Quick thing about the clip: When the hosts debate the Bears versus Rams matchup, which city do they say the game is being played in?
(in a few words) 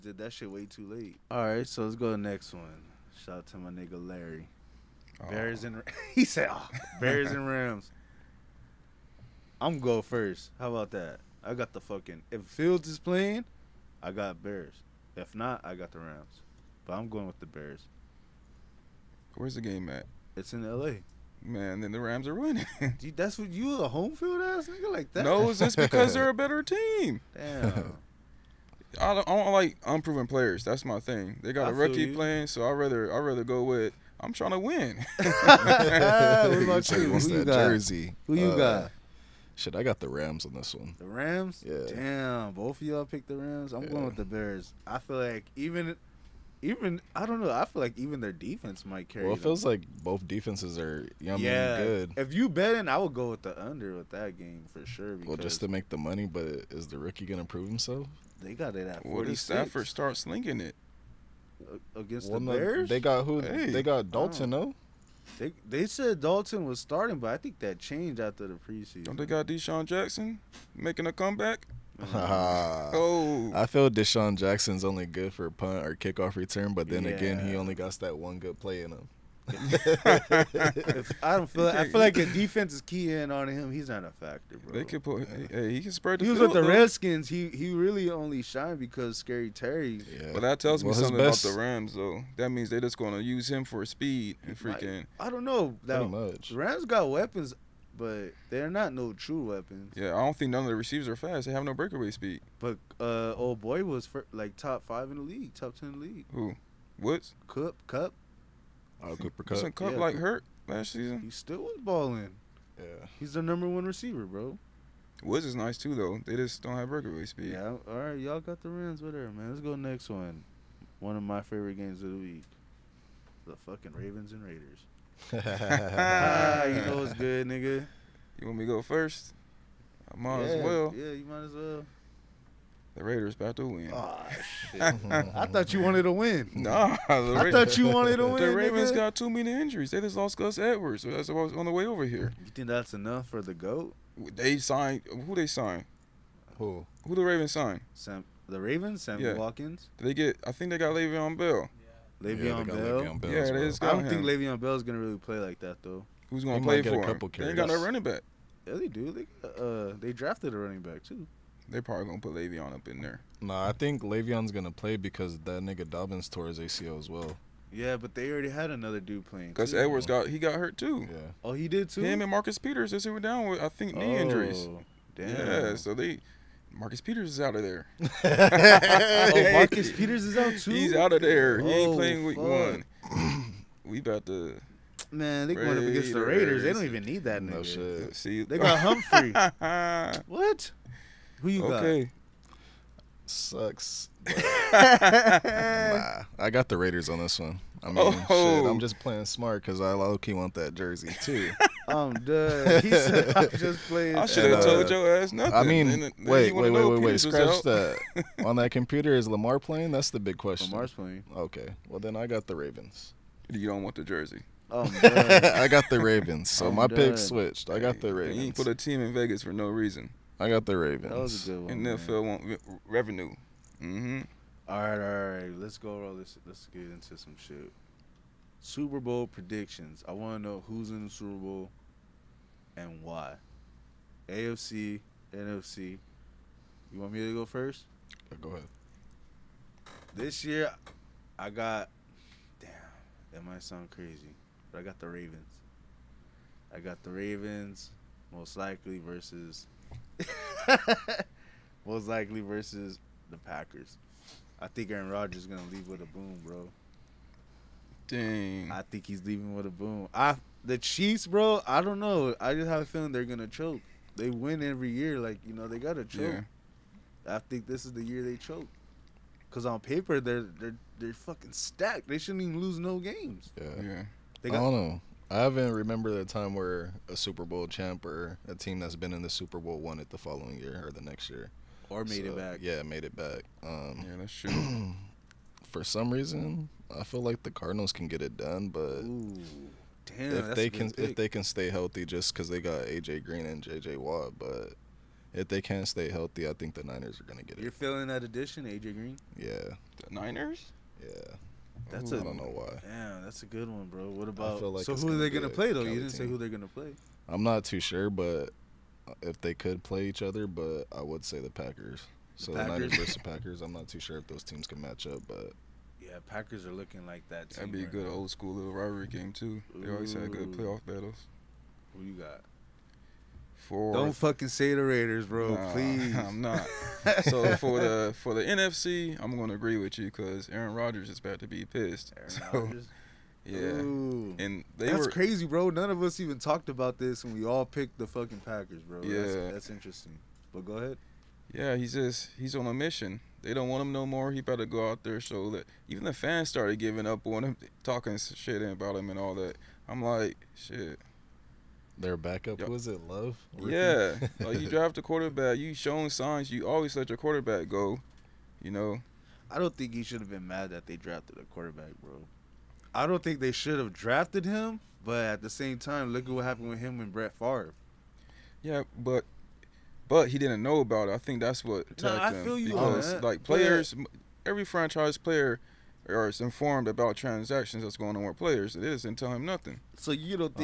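L.A.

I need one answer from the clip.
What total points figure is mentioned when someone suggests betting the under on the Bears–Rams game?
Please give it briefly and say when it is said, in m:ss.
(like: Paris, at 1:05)
46, at 0:59.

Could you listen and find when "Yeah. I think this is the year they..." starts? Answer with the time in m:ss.
4:26.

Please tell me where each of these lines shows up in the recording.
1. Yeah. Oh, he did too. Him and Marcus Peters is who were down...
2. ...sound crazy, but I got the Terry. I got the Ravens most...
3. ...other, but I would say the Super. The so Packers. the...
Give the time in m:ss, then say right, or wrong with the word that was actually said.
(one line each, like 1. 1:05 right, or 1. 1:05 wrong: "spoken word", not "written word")
1. 2:51 right
2. 4:03 wrong: "Ravens", not "Terry"
3. 5:10 wrong: "Packers", not "Super".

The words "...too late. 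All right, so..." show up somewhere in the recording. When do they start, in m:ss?
0:00.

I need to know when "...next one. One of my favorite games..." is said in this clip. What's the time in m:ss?
1:59.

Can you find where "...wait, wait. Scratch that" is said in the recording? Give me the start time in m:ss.
3:26.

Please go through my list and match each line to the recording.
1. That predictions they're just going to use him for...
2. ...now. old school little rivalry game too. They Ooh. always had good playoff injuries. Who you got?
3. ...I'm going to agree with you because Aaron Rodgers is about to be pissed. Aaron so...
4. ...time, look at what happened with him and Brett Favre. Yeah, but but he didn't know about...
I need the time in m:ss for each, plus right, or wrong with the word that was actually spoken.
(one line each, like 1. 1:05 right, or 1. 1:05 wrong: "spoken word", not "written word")
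1. 1:32 wrong: "means", not "predictions"
2. 5:18 wrong: "battles", not "injuries"
3. 5:29 right
4. 6:05 right.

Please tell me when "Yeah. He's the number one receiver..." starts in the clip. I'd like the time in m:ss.
1:52.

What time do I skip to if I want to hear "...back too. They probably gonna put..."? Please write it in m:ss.
2:40.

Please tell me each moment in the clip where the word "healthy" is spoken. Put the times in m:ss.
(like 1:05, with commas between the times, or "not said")
4:51, 4:56.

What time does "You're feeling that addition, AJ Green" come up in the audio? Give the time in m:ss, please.
4:57.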